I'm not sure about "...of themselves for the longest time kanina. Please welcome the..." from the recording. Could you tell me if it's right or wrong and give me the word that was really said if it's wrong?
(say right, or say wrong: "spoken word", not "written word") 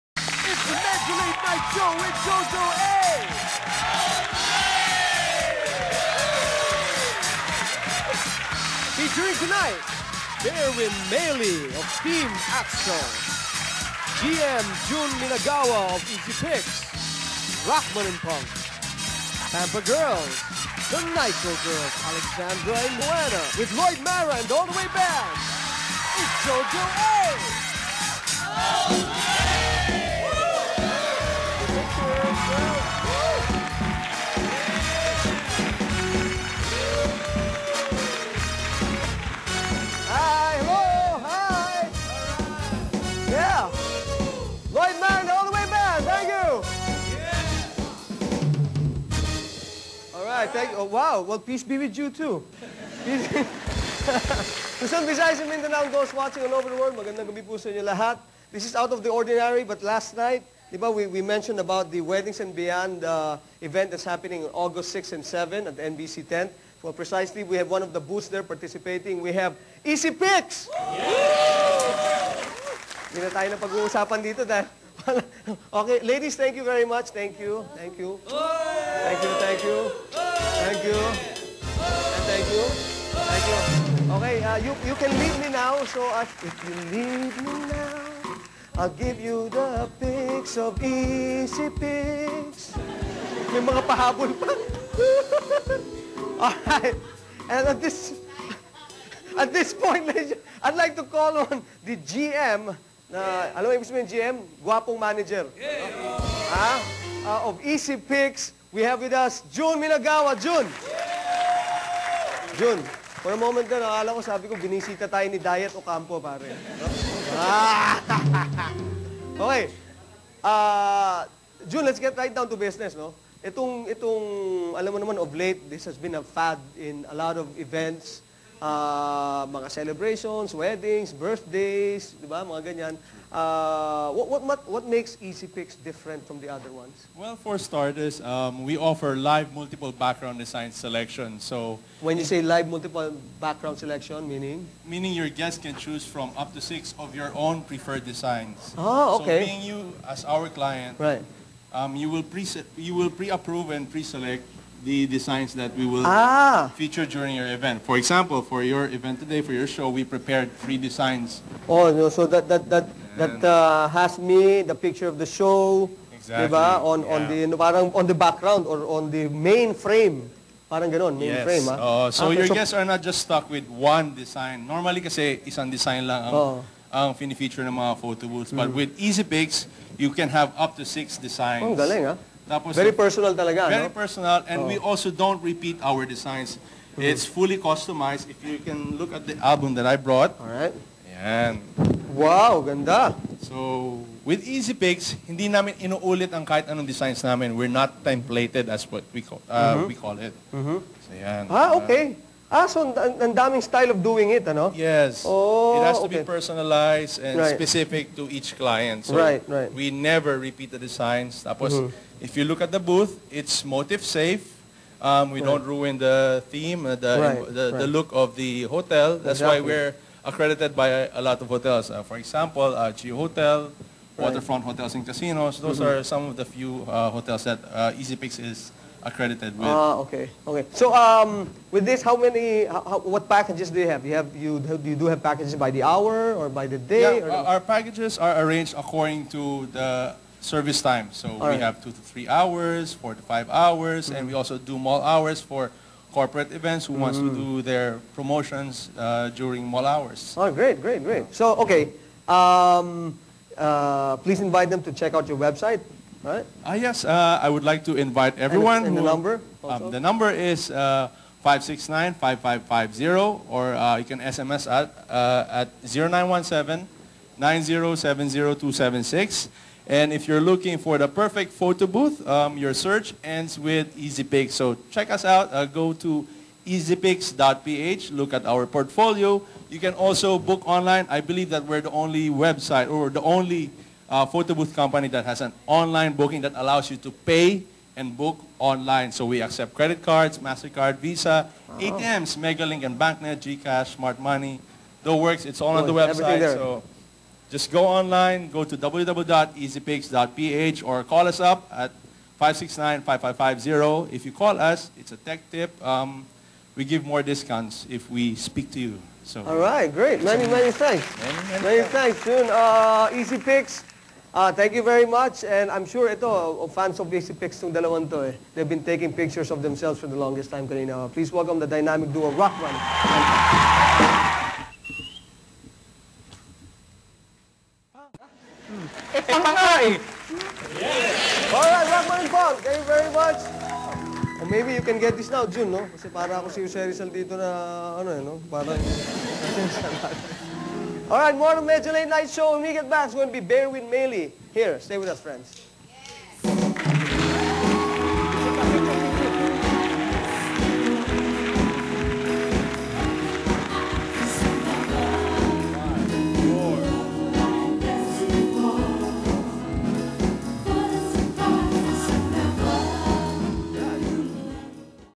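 right.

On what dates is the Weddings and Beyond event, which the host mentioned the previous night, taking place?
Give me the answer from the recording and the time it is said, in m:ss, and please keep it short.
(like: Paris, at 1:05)
August 6 and 7, at 1:04.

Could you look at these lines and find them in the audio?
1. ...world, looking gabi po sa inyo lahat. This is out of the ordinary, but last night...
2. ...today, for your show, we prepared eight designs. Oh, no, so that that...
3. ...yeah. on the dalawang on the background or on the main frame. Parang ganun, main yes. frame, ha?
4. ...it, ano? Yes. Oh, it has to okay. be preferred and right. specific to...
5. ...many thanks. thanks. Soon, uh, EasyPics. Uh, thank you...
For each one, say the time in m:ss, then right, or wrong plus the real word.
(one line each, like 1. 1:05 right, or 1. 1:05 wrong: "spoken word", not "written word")
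1. 0:56 wrong: "magandang", not "looking"
2. 2:39 wrong: "three", not "eight"
3. 2:47 wrong: "parang", not "dalawang"
4. 3:24 wrong: "personalized", not "preferred"
5. 5:11 right.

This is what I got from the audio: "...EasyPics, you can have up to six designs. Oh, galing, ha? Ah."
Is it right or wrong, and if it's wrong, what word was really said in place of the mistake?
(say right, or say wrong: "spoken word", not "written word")
right.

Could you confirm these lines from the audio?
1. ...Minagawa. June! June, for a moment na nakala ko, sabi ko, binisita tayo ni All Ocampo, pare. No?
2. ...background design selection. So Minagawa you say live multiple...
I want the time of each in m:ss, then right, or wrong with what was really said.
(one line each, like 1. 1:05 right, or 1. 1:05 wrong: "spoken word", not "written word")
1. 1:49 wrong: "Diet", not "All"
2. 2:19 wrong: "When", not "Minagawa".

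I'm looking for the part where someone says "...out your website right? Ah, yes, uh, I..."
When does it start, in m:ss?
4:15.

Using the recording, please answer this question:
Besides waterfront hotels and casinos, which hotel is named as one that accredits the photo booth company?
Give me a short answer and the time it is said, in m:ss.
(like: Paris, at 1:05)
Geo Hotel, at 3:42.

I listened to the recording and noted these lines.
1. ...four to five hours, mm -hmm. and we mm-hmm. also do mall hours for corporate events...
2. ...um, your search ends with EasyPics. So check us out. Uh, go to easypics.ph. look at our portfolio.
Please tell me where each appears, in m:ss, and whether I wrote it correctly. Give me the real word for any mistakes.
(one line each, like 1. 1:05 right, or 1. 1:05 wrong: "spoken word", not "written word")
1. 4:02 right
2. 4:32 right.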